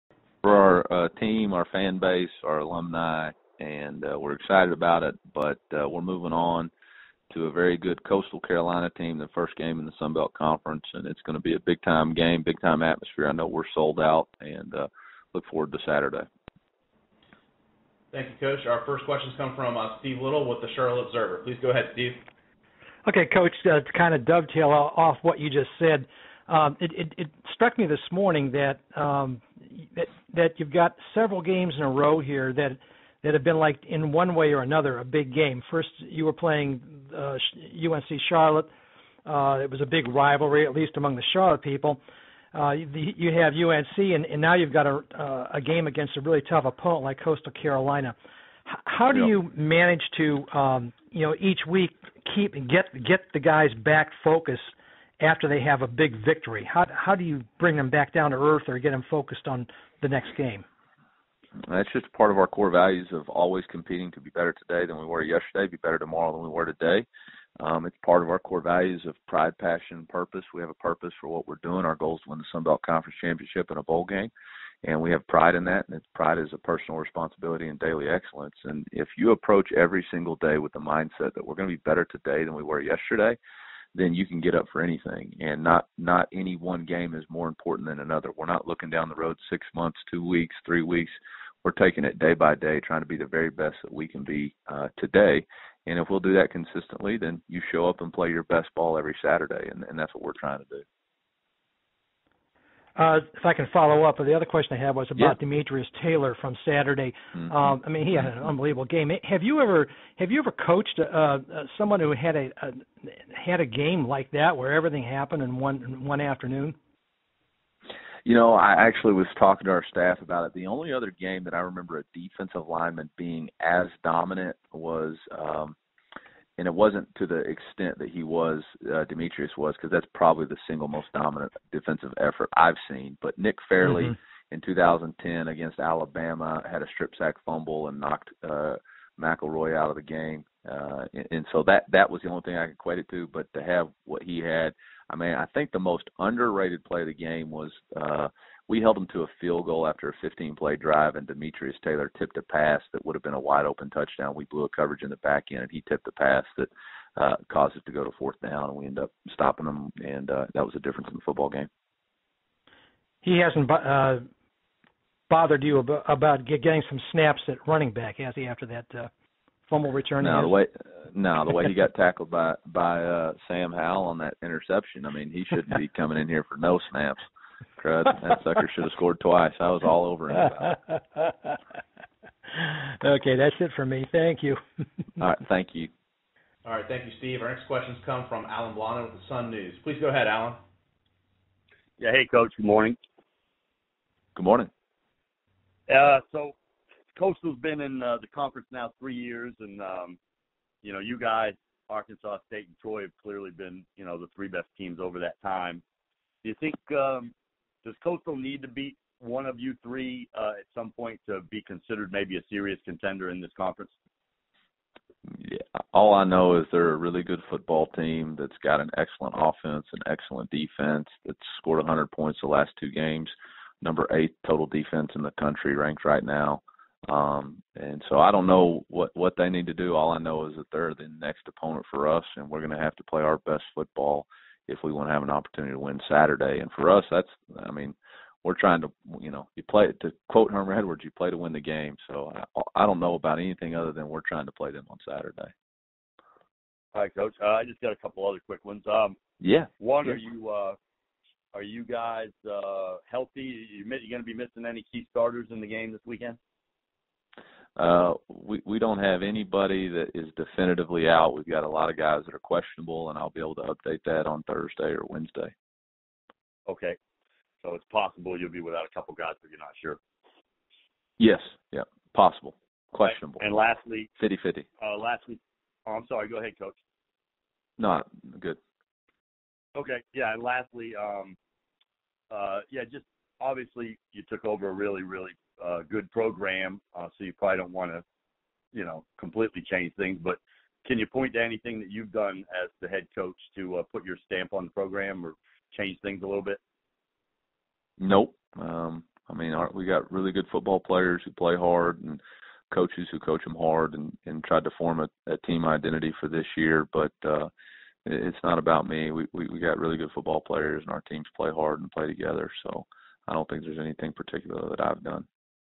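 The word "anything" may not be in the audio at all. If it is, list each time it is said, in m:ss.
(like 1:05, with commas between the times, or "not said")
1:24, 4:03, 4:51, 5:13.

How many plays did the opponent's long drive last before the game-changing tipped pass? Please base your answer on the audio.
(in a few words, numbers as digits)
15.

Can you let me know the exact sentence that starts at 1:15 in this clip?
And pride is a personal responsibility and daily excellence.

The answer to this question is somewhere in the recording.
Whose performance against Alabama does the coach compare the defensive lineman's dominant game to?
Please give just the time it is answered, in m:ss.
2:13.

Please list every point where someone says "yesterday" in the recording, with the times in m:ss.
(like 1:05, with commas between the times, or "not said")
1:05, 1:22.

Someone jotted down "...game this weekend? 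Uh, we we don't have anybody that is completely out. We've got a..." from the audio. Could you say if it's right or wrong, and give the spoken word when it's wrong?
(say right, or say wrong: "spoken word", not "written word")
wrong: "definitively", not "completely".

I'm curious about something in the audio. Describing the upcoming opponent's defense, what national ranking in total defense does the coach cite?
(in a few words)
8.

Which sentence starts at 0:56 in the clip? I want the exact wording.
How how do you bring them back down to earth or get them focused on the next game?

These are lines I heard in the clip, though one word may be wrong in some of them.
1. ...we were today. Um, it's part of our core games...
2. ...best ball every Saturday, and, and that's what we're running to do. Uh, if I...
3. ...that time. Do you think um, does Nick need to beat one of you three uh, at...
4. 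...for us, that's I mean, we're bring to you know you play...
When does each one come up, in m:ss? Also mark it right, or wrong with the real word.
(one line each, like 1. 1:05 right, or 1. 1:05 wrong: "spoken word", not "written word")
1. 1:06 wrong: "values", not "games"
2. 1:38 wrong: "trying", not "running"
3. 3:25 wrong: "Coastal", not "Nick"
4. 3:56 wrong: "trying", not "bring".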